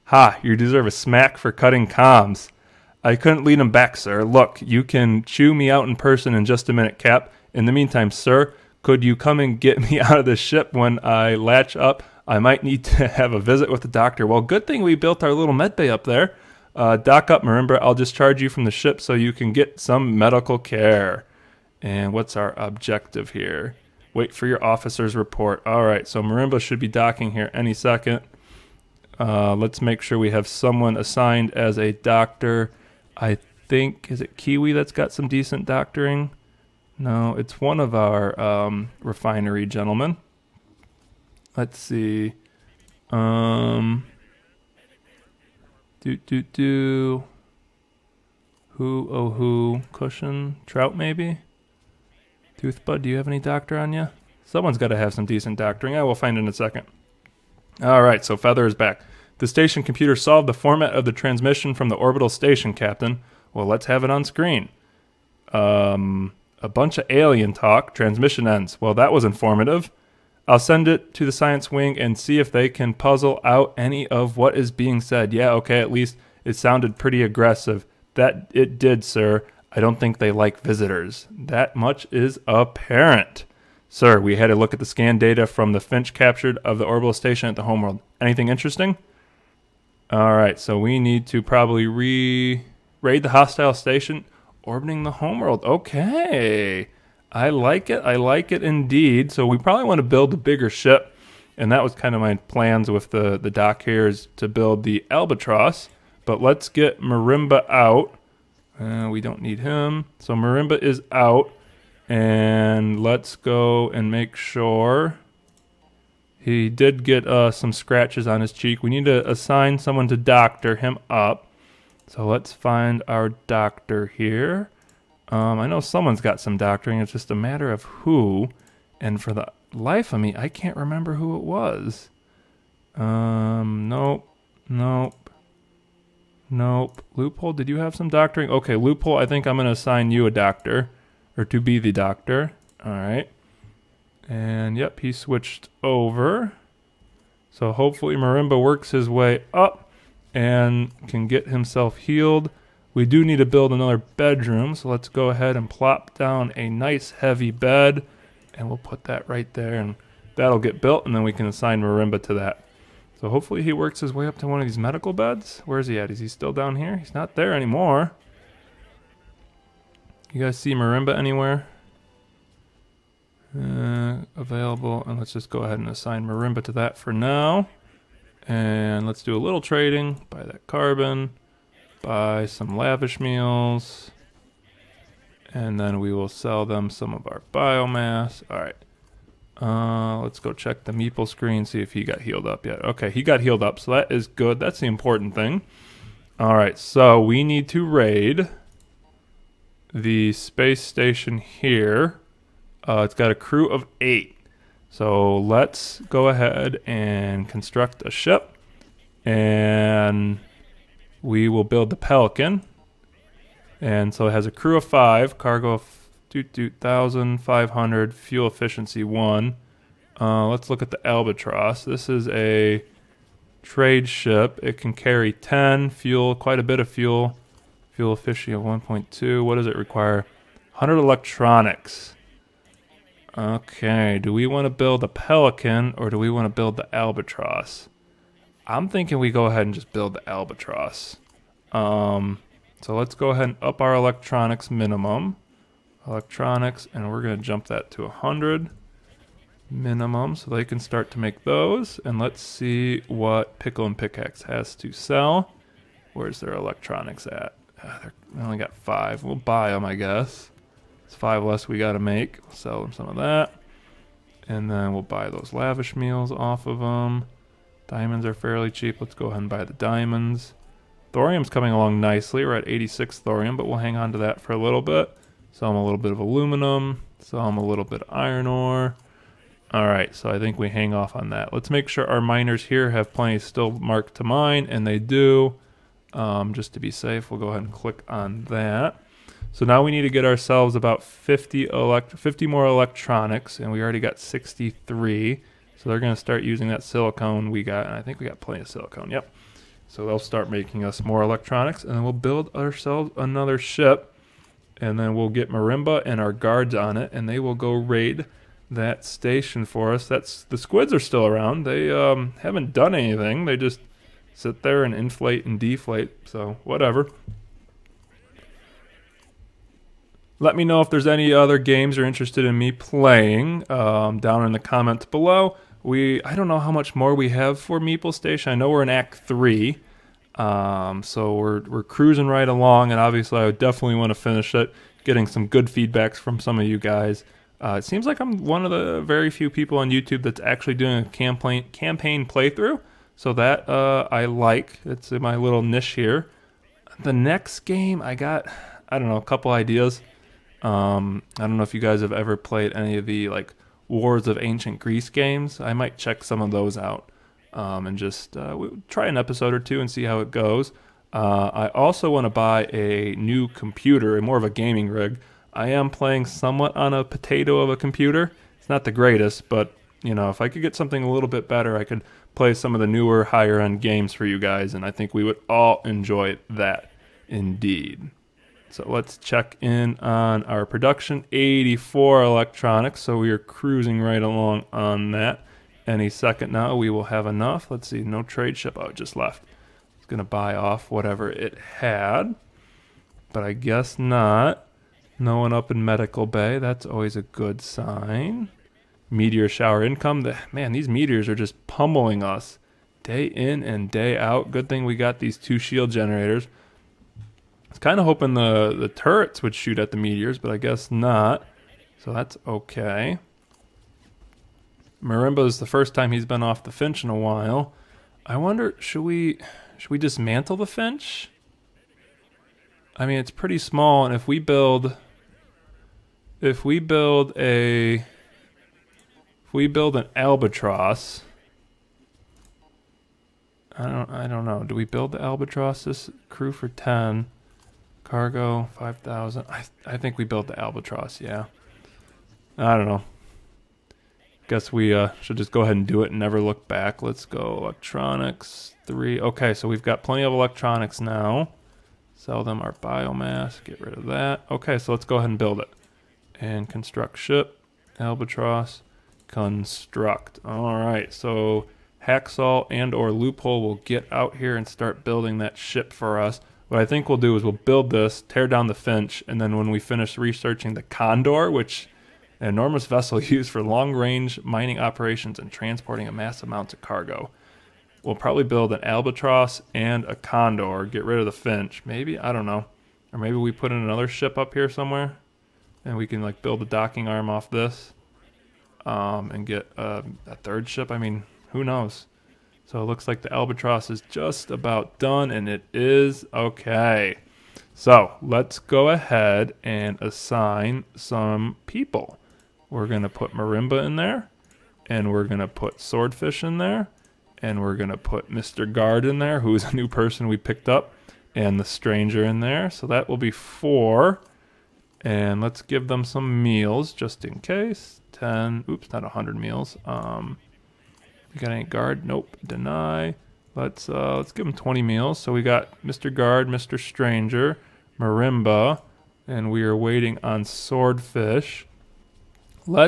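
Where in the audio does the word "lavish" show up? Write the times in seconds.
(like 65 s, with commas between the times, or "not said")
182 s, 265 s.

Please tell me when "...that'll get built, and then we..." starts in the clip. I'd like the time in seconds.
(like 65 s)
160 s.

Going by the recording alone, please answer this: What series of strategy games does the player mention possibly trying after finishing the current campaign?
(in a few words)
Wars of Ancient Greece.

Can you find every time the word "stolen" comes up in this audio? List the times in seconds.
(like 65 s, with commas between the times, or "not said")
not said.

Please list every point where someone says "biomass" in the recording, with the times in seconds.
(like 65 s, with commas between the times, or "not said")
187 s, 452 s.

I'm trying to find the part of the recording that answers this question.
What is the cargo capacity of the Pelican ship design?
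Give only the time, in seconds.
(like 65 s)
216 s.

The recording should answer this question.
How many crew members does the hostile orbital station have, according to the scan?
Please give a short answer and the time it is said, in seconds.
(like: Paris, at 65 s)
8, at 203 s.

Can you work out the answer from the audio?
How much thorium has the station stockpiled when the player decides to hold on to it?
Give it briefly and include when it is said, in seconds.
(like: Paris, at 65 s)
86, at 272 s.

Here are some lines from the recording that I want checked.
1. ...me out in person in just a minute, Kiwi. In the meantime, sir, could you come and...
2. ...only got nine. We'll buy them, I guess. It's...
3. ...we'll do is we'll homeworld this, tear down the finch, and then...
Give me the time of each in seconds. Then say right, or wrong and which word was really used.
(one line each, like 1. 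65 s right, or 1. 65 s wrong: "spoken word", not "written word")
1. 5 s wrong: "Cap", not "Kiwi"
2. 258 s wrong: "five", not "nine"
3. 467 s wrong: "build", not "homeworld".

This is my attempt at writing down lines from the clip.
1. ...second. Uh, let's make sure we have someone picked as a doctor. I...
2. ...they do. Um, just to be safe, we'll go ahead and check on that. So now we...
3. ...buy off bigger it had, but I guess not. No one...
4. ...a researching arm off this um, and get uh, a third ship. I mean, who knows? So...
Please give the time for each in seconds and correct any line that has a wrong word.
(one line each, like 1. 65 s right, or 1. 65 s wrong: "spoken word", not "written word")
1. 27 s wrong: "assigned", not "picked"
2. 284 s wrong: "click", not "check"
3. 390 s wrong: "whatever", not "bigger"
4. 486 s wrong: "docking", not "researching".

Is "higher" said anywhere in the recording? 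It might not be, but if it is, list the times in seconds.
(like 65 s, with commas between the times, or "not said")
373 s.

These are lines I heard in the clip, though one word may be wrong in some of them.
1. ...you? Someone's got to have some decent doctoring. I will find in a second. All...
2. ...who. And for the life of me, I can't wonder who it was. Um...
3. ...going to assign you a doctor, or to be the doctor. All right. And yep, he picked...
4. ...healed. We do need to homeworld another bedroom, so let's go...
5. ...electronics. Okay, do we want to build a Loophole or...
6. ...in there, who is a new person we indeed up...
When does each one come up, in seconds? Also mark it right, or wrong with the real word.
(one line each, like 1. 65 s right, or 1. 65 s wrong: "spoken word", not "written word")
1. 53 s right
2. 127 s wrong: "remember", not "wonder"
3. 139 s wrong: "switched", not "picked"
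4. 151 s wrong: "build", not "homeworld"
5. 230 s wrong: "Pelican", not "Loophole"
6. 509 s wrong: "picked", not "indeed".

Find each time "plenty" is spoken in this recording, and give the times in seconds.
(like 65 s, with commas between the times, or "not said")
283 s, 298 s, 450 s.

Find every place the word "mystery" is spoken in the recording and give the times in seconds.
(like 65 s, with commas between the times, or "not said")
not said.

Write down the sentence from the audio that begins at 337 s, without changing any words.
Uh, it seems like I'm one of the very few people on YouTube that's actually doing a campaign campaign playthrough.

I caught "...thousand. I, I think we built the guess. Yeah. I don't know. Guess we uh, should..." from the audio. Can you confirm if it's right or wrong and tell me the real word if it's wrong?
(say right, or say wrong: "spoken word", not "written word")
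wrong: "albatross", not "guess".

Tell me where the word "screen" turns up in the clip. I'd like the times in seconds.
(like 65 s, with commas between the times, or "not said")
64 s, 191 s.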